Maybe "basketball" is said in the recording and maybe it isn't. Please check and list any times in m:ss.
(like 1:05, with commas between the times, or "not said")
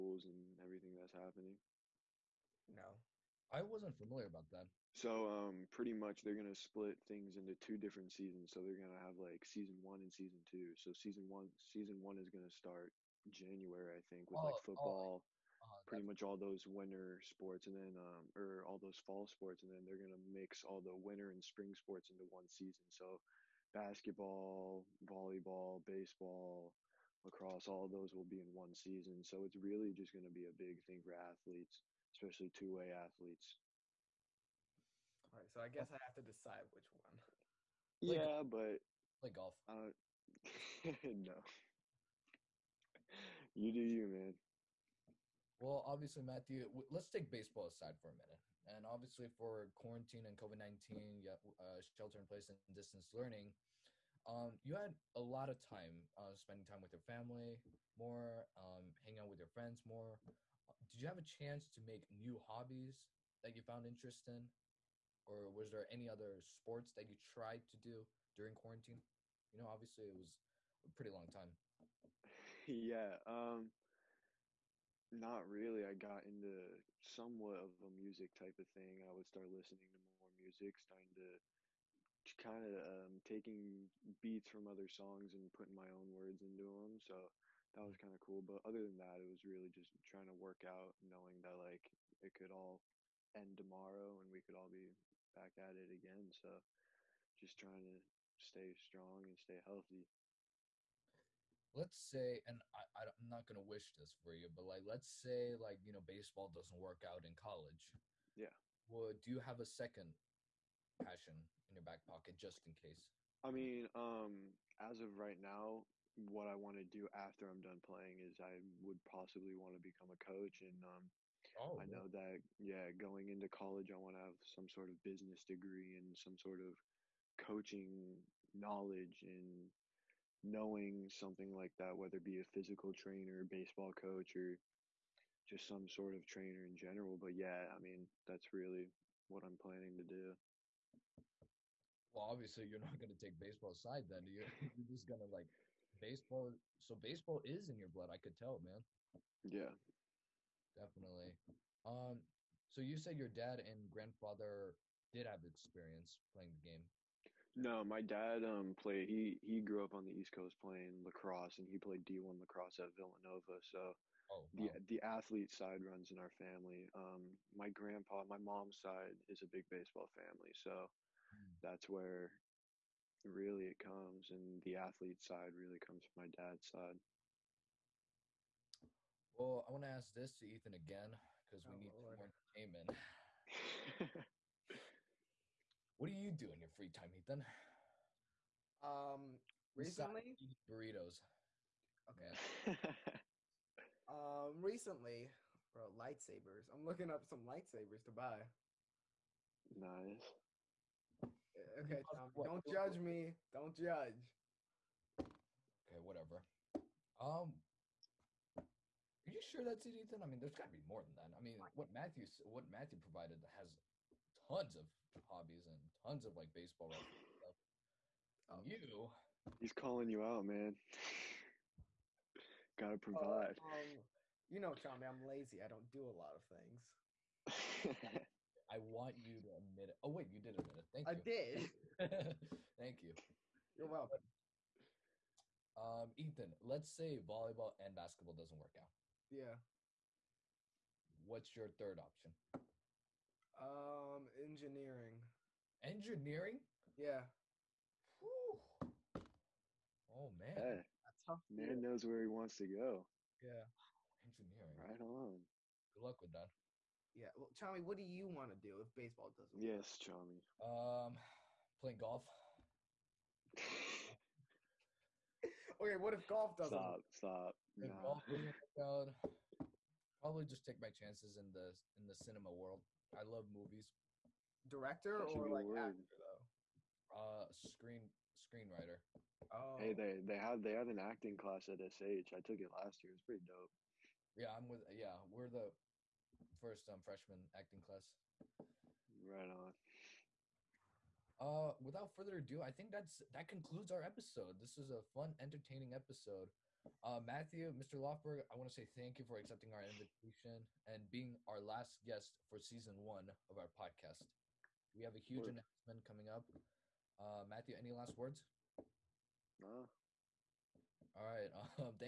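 0:23, 3:57.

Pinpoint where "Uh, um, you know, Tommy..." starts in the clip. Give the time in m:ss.
3:43.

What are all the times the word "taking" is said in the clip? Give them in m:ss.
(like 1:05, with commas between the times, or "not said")
1:23.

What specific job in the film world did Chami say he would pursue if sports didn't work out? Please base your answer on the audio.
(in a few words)
Screenwriter.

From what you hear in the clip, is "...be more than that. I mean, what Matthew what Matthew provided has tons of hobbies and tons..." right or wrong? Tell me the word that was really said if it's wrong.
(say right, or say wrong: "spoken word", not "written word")
right.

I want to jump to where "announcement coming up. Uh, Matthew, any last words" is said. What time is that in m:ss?
5:05.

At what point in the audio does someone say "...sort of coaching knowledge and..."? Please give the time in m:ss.
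2:06.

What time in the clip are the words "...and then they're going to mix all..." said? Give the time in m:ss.
0:19.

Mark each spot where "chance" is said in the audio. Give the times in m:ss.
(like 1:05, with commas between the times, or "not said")
1:01, 4:30.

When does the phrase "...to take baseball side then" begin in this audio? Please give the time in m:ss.
2:23.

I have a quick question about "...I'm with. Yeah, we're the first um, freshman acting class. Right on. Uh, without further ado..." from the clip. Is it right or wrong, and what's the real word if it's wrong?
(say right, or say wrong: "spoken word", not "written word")
right.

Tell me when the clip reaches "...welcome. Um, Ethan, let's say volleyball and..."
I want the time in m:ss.
3:53.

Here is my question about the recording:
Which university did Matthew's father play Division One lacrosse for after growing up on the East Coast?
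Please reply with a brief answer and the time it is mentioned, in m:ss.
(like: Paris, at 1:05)
Villanova, at 2:42.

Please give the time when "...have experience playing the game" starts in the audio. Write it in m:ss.
2:35.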